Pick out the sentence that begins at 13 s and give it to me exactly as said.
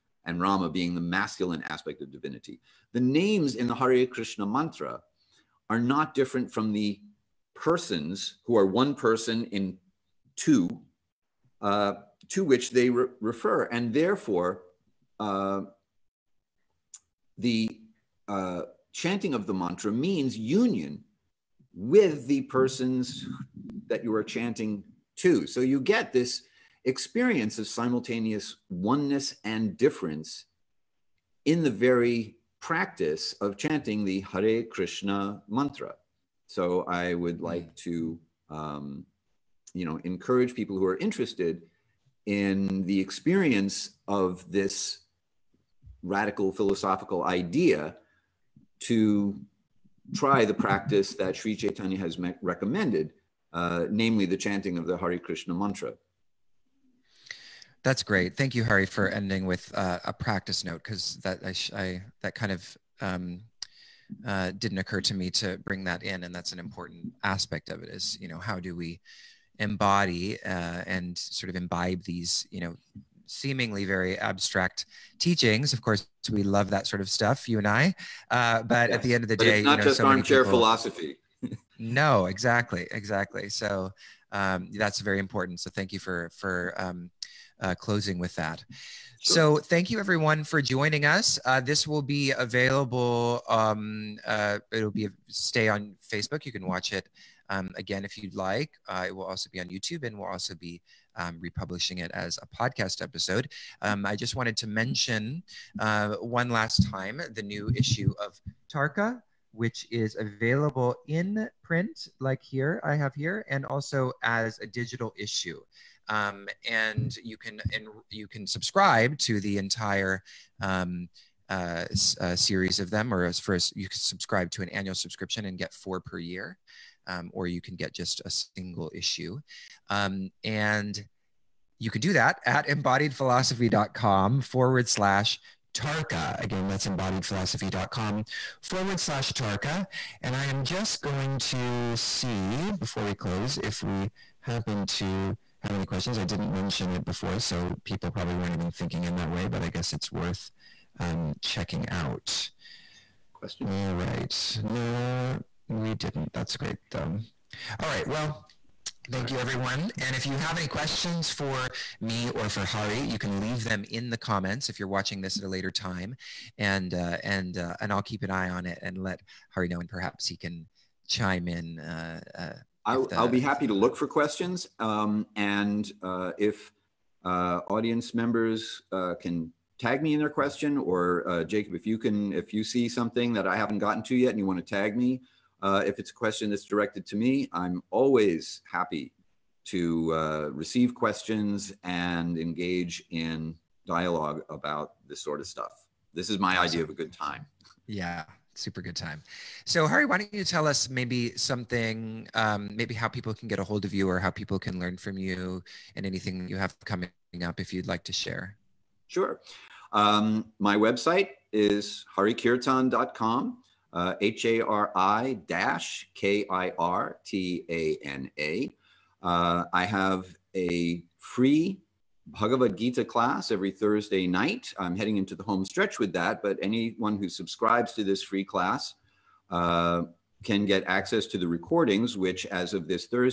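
And therefore, uh, the uh, chanting of the mantra means union with the persons that you are chanting to.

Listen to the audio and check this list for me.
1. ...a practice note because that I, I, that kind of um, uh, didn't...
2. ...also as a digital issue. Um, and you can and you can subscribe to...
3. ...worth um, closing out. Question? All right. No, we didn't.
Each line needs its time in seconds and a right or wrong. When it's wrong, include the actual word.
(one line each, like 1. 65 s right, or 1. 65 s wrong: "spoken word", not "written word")
1. 60 s right
2. 113 s right
3. 150 s wrong: "checking", not "closing".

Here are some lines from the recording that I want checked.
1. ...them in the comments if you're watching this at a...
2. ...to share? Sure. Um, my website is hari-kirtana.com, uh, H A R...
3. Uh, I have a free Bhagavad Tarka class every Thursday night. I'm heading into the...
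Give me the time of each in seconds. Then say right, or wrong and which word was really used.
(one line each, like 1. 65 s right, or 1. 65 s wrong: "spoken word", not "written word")
1. 163 s right
2. 208 s right
3. 219 s wrong: "Gita", not "Tarka".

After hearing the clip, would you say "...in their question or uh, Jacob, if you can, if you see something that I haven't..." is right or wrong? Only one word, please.
right.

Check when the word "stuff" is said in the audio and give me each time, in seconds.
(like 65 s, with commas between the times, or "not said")
77 s, 195 s.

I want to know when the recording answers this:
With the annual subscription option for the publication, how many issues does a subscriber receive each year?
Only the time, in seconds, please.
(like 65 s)
125 s.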